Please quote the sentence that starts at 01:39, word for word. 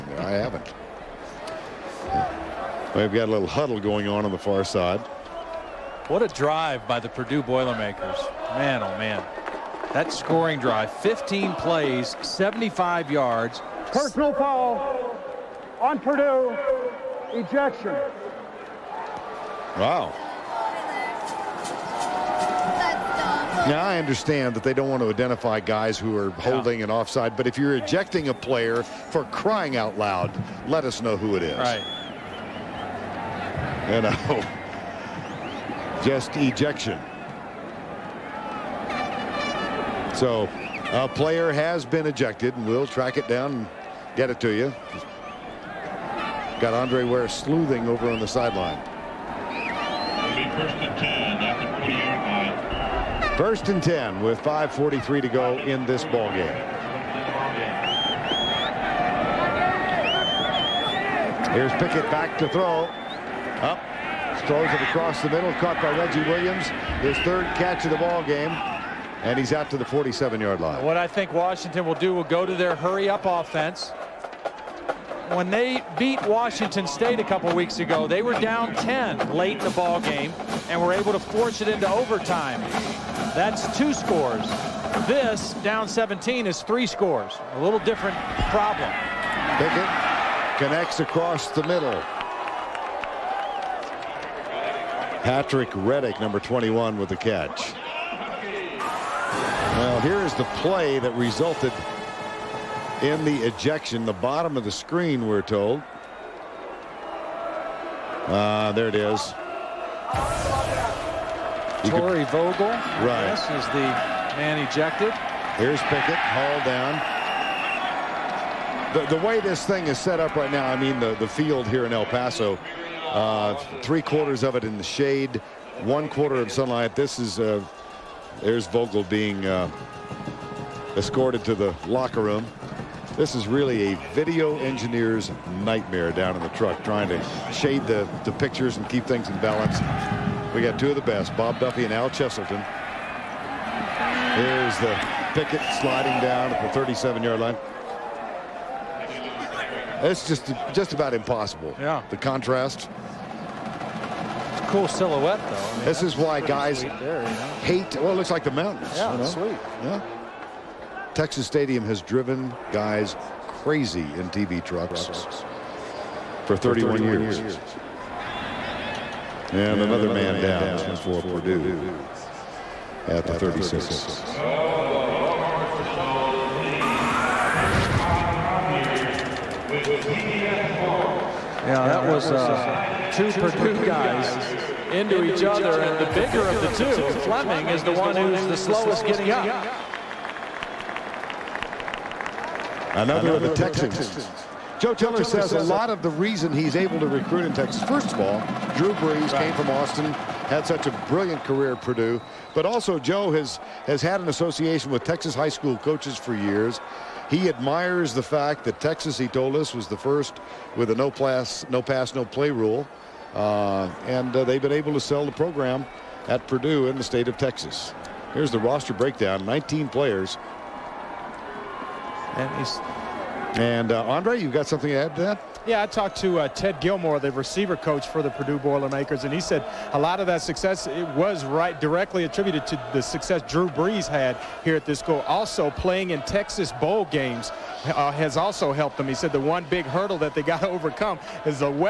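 Well, here is the play that resulted in the ejection.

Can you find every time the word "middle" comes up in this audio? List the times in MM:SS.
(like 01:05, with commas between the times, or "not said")
01:05, 01:31.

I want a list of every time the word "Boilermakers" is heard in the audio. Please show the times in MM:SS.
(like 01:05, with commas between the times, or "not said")
00:07, 03:48.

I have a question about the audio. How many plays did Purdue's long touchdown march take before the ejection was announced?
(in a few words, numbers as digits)
15.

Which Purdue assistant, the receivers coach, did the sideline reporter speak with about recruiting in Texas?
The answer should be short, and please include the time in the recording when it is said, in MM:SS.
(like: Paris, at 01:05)
Ted Gilmore, at 03:46.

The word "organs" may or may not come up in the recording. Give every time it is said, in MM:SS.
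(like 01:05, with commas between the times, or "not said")
not said.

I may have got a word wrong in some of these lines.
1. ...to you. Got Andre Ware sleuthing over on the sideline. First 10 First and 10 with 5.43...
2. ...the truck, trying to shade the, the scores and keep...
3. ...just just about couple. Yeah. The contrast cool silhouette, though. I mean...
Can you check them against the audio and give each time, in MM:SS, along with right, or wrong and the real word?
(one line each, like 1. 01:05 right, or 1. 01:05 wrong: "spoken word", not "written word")
1. 00:44 right
2. 02:16 wrong: "pictures", not "scores"
3. 02:30 wrong: "impossible", not "couple".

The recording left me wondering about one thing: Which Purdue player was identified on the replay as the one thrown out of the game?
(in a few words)
Torrey Vogel.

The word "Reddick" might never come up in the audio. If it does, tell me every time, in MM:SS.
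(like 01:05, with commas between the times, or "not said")
01:35.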